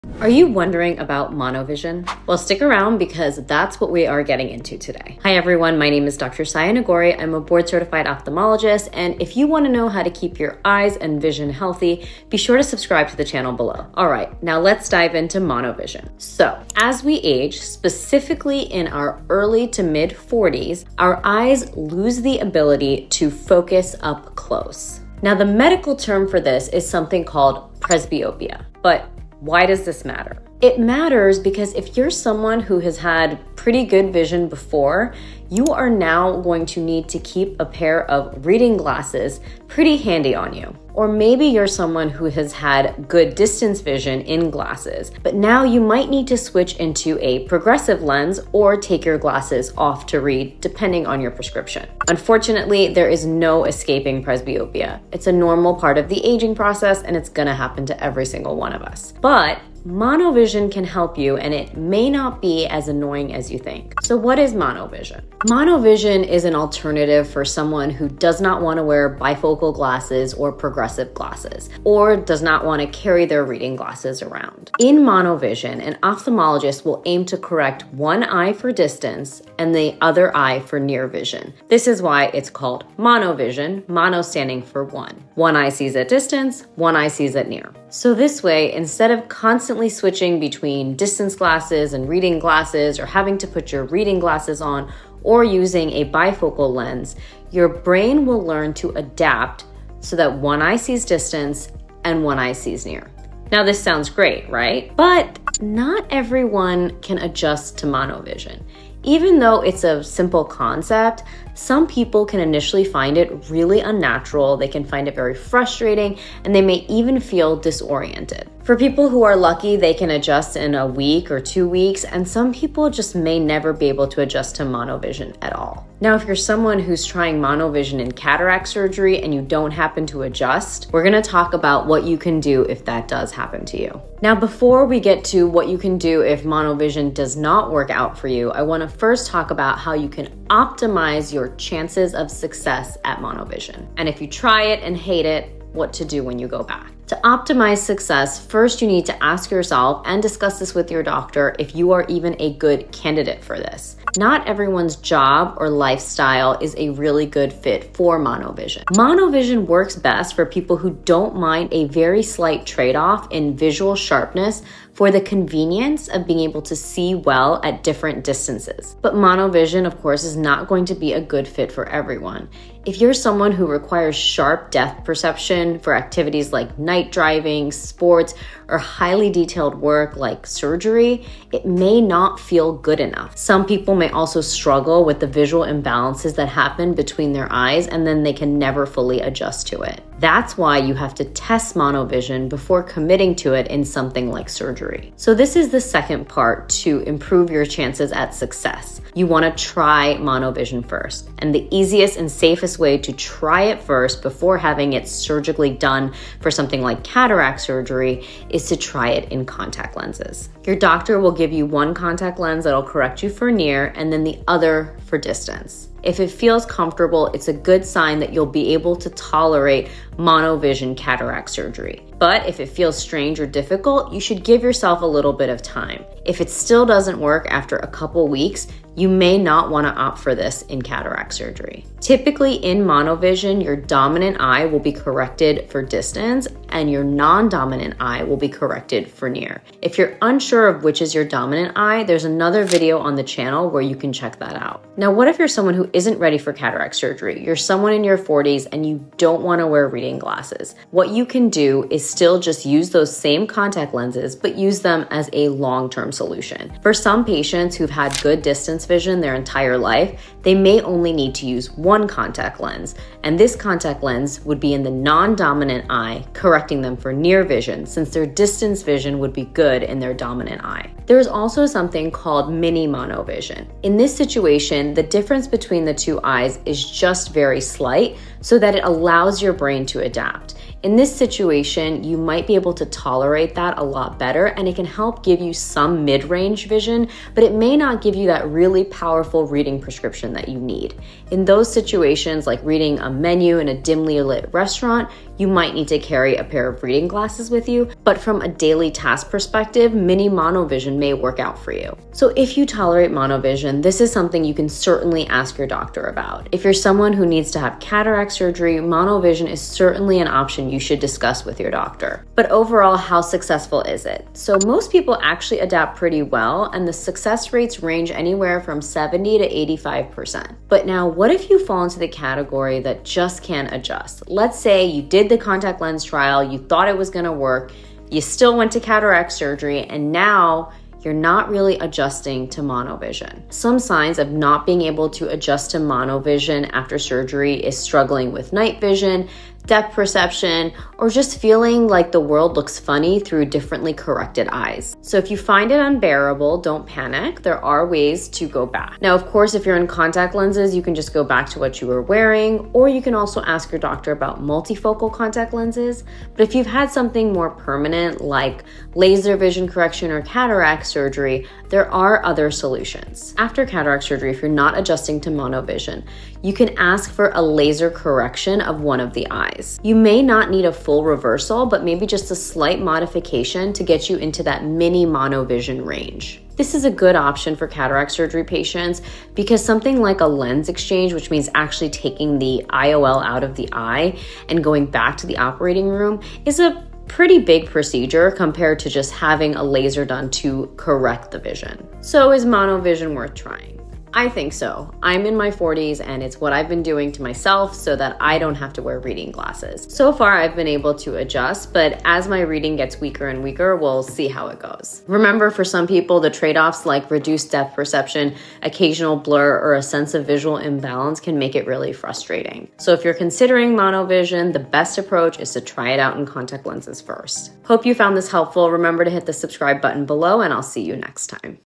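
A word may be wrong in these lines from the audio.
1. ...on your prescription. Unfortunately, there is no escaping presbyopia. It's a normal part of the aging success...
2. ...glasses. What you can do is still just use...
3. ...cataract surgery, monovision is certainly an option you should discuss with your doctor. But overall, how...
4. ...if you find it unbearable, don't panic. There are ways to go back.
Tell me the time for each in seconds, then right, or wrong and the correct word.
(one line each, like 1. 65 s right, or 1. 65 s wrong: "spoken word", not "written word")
1. 51 s wrong: "process", not "success"
2. 250 s right
3. 307 s right
4. 345 s right.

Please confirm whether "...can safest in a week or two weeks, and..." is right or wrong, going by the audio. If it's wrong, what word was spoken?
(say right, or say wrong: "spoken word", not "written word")
wrong: "adjust", not "safest".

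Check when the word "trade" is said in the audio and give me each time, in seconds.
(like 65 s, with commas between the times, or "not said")
162 s, 406 s.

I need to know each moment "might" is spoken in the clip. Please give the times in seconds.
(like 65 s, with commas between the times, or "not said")
45 s, 282 s, 295 s.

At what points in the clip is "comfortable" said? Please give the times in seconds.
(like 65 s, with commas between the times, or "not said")
216 s.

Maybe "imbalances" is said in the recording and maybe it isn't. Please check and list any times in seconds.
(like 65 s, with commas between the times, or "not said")
185 s, 410 s.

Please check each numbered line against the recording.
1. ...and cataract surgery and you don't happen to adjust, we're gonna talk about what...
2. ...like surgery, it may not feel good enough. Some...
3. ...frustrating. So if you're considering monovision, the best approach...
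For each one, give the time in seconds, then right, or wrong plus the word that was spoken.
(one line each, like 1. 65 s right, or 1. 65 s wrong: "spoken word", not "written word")
1. 128 s right
2. 180 s right
3. 411 s right.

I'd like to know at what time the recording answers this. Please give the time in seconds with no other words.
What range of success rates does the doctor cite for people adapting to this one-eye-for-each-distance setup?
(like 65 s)
318 s.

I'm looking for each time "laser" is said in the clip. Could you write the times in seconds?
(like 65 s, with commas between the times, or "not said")
358 s, 367 s, 389 s.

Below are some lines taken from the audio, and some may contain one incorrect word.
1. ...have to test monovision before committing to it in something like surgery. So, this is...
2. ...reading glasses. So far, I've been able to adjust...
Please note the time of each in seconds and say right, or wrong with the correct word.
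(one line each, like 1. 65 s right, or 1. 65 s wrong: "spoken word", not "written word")
1. 190 s right
2. 398 s right.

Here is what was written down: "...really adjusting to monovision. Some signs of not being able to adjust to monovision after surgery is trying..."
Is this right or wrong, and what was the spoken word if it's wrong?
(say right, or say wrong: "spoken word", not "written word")
wrong: "struggling", not "trying".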